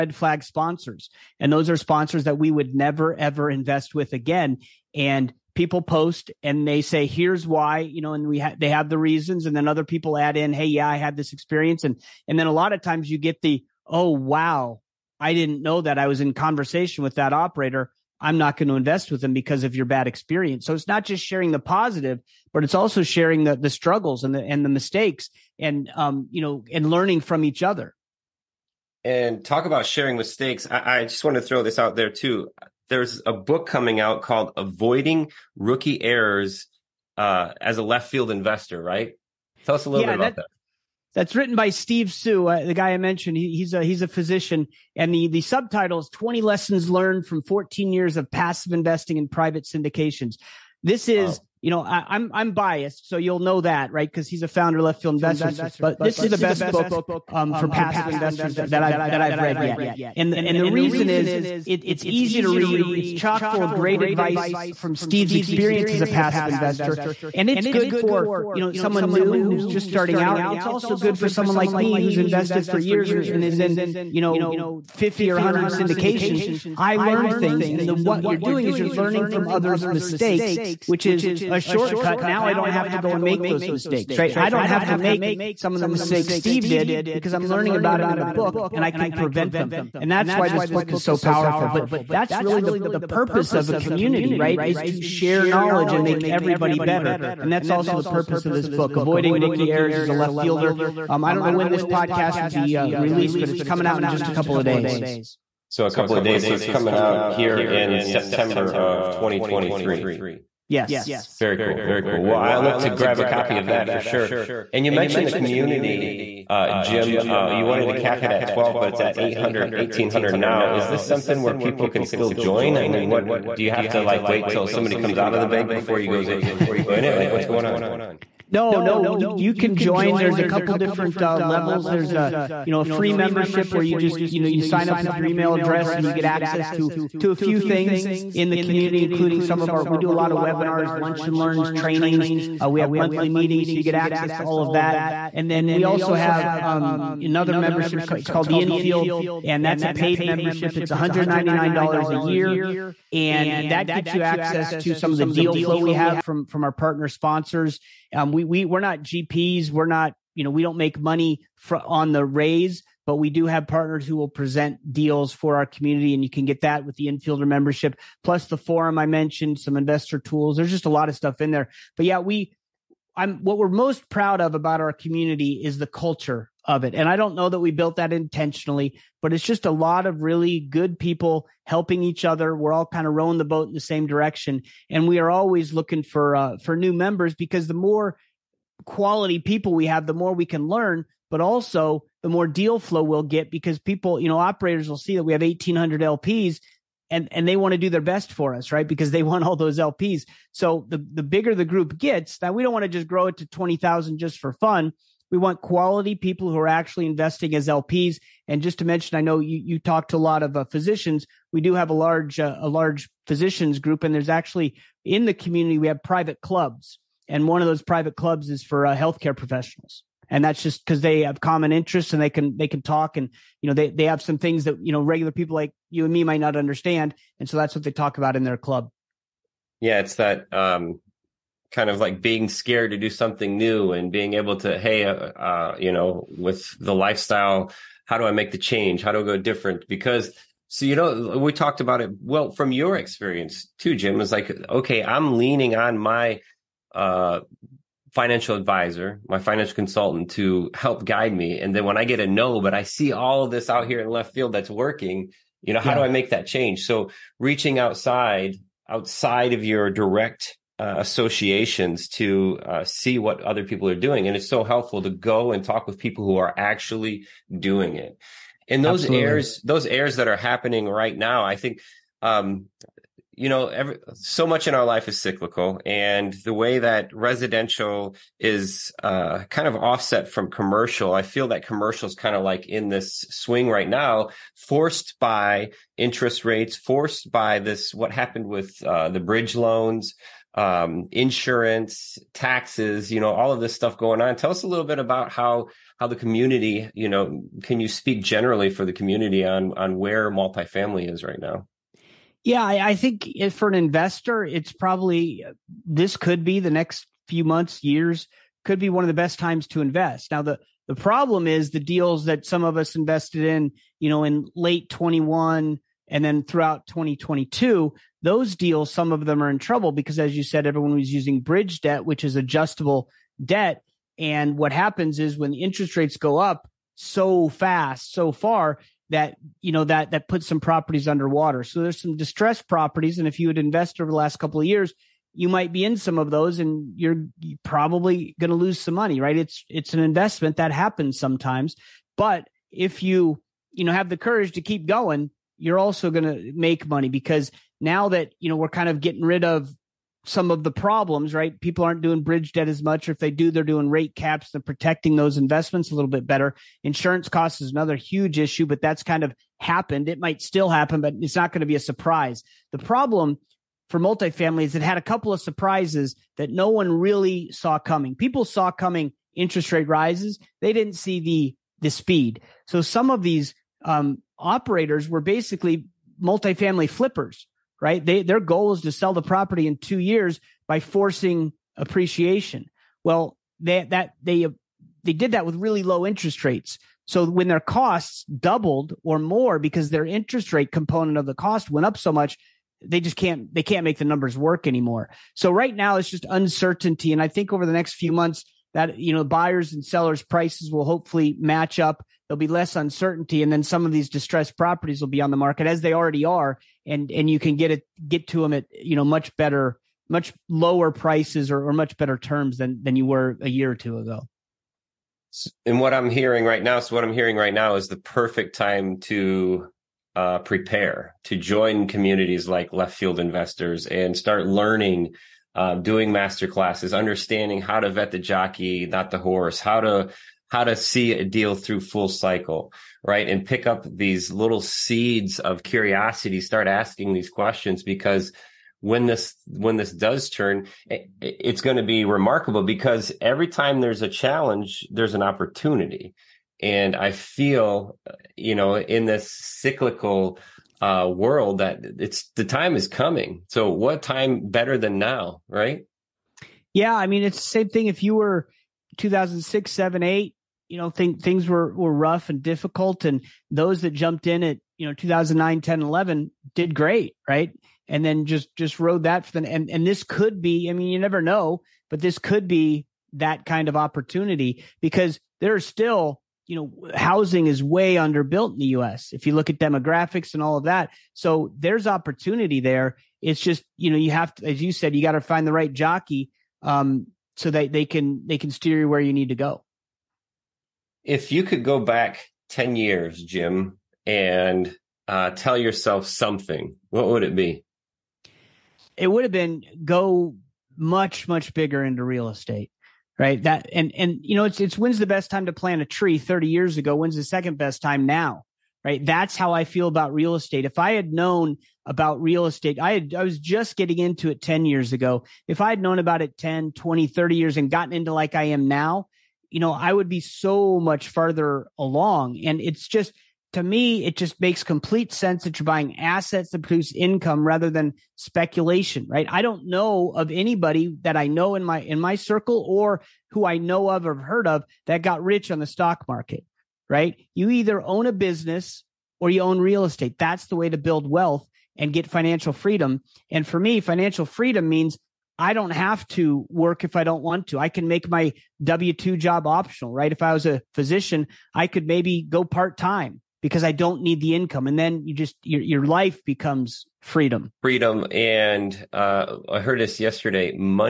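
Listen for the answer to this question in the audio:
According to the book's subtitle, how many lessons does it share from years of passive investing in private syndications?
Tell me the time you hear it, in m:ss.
0:46.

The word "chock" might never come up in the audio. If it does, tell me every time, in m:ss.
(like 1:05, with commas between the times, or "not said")
1:03.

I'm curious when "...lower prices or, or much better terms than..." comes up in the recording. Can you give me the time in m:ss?
6:50.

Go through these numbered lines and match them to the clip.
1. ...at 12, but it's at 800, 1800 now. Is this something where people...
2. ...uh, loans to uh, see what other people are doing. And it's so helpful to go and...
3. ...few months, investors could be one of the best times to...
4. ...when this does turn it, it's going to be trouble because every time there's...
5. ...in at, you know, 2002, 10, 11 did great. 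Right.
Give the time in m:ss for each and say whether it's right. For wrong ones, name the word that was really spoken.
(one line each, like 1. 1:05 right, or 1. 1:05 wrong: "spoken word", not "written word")
1. 1:58 right
2. 4:20 wrong: "associations", not "loans"
3. 5:07 wrong: "years", not "investors"
4. 7:19 wrong: "remarkable", not "trouble"
5. 7:44 wrong: "2009", not "2002".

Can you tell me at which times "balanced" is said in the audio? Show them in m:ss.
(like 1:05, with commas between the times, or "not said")
not said.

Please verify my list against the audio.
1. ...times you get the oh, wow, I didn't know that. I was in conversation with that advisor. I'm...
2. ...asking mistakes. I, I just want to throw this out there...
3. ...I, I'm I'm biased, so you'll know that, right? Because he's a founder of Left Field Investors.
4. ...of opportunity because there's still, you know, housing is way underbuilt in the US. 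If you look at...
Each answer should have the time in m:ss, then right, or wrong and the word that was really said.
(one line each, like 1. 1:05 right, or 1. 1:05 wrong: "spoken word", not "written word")
1. 0:12 wrong: "operator", not "advisor"
2. 0:29 wrong: "sharing", not "asking"
3. 0:51 right
4. 7:53 right.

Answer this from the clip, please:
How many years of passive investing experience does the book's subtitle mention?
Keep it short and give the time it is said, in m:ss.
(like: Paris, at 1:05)
14, at 0:47.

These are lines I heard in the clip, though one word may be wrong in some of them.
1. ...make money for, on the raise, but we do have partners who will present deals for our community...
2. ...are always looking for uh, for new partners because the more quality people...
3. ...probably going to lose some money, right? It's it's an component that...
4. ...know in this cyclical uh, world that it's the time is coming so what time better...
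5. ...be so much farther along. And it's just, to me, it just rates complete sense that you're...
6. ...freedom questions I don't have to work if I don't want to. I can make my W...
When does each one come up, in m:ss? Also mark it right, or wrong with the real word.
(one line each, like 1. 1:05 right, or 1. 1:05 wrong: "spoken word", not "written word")
1. 2:40 right
2. 3:05 wrong: "members", not "partners"
3. 5:37 wrong: "investment", not "component"
4. 7:28 right
5. 8:40 wrong: "makes", not "rates"
6. 9:04 wrong: "means", not "questions".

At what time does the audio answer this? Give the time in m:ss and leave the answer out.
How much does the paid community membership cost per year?
2:30.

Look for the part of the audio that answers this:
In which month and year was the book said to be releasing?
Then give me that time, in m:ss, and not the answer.
1:48.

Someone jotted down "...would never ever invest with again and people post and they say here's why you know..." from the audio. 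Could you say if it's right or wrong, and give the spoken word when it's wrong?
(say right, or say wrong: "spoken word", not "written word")
right.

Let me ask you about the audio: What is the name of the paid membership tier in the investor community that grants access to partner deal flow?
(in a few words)
Infield.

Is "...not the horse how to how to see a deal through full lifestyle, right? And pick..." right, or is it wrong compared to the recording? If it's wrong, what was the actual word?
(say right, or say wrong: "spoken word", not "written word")
wrong: "cycle", not "lifestyle".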